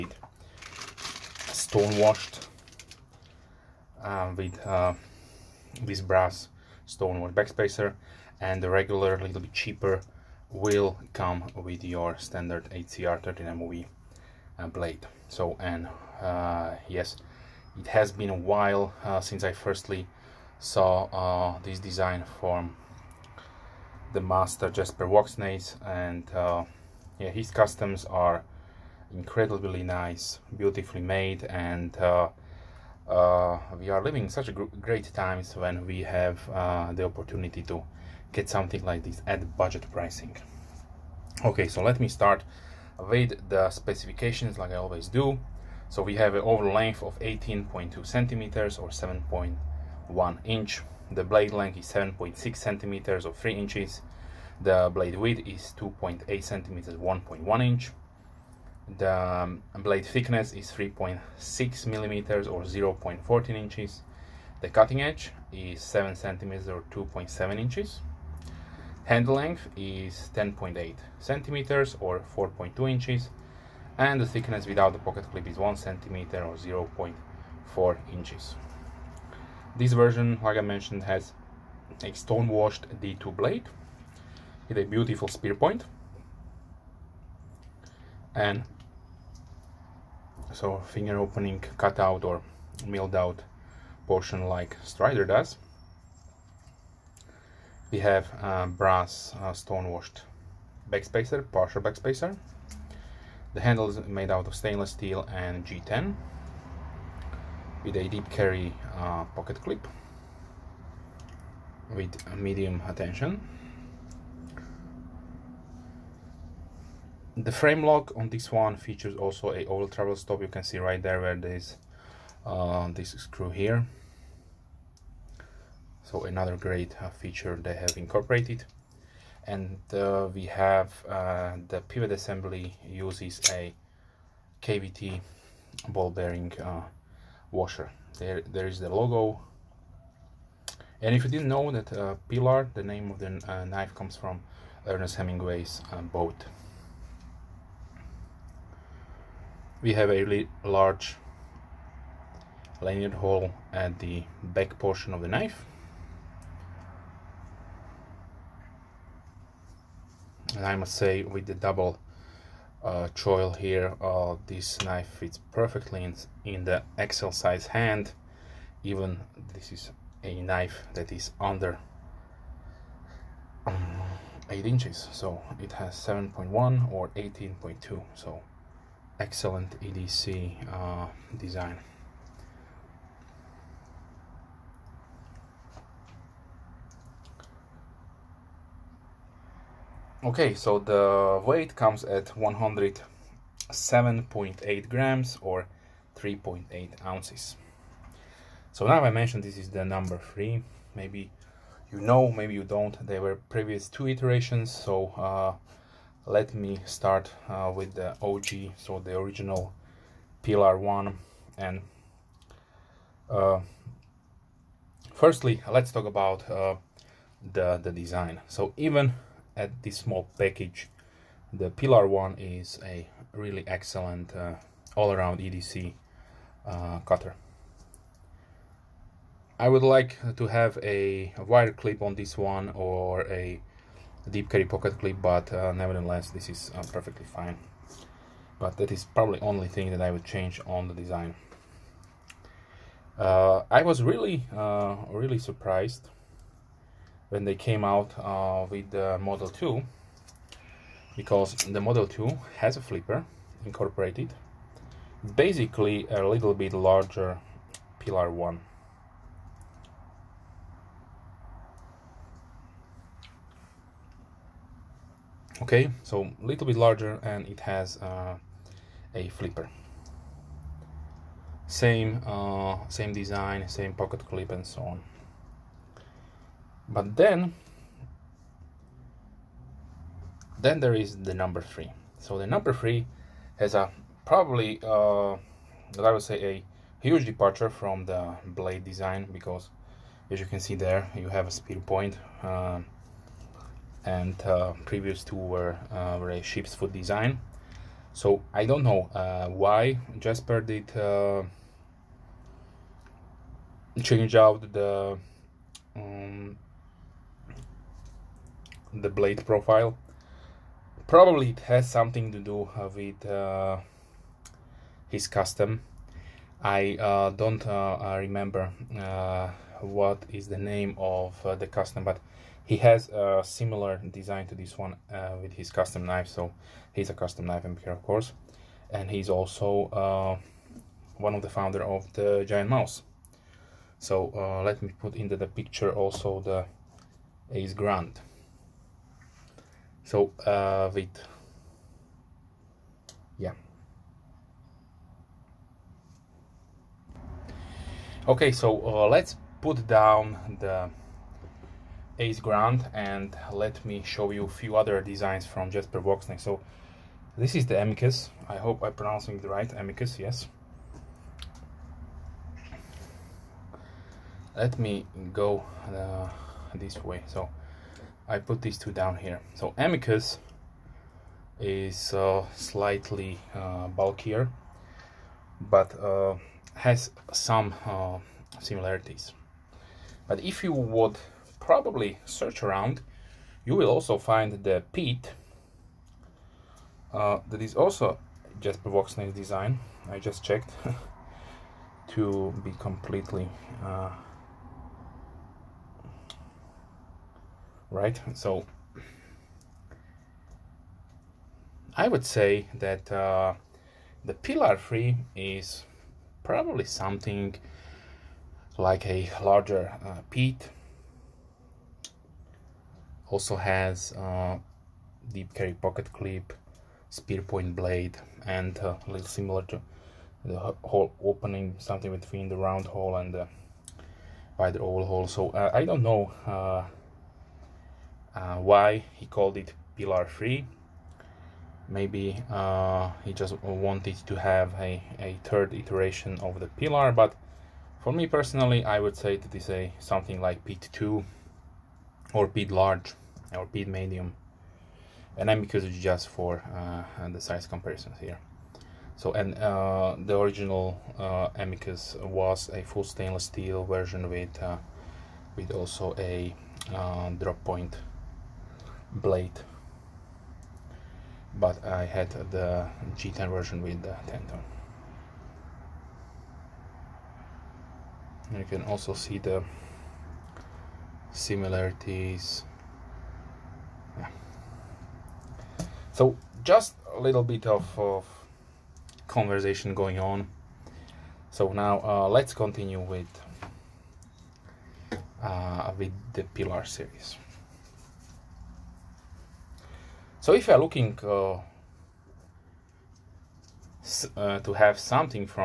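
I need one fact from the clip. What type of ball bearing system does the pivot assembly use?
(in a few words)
KVT.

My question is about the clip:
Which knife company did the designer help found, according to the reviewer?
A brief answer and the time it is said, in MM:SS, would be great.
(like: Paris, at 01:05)
Giant Mouse, at 05:32.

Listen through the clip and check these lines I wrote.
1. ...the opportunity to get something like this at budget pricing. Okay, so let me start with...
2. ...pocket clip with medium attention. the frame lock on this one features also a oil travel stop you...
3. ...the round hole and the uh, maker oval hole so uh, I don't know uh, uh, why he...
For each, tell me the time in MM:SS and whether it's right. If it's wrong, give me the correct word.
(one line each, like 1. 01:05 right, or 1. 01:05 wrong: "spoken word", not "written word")
1. 00:36 right
2. 01:49 right
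3. 07:02 wrong: "wider", not "maker".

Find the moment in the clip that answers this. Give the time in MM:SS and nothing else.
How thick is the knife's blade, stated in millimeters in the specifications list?
01:00.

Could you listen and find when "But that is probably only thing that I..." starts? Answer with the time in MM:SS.
03:58.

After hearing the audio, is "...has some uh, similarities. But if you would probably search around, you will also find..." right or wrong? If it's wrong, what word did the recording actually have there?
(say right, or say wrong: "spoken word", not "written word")
right.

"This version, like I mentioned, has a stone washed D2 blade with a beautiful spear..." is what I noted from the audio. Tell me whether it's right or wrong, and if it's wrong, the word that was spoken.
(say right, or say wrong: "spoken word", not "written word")
right.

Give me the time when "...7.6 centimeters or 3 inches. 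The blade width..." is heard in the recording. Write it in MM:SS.
00:51.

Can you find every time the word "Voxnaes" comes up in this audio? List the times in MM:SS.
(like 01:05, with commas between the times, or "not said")
00:25, 05:55, 06:28.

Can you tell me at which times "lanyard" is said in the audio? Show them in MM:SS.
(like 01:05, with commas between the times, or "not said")
02:32.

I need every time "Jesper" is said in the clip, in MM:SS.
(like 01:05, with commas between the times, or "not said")
00:24, 05:00, 05:55, 06:28.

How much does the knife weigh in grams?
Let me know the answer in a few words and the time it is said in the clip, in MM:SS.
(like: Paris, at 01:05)
107.8 grams, at 03:12.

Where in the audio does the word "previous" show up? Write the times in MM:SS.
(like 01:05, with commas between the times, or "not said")
03:23, 04:54.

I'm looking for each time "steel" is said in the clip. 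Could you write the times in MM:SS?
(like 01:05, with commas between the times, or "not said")
01:44, 07:33.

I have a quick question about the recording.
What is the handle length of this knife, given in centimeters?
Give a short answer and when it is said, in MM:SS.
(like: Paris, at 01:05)
10.8 centimeters, at 01:10.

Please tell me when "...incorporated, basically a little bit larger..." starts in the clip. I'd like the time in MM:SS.
04:13.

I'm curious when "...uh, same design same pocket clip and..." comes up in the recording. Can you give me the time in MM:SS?
04:32.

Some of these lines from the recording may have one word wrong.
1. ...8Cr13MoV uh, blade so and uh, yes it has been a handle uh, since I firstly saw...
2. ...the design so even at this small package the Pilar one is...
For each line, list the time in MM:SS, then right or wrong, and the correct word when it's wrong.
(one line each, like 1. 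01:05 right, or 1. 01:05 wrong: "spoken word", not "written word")
1. 00:12 wrong: "while", not "handle"
2. 03:37 right.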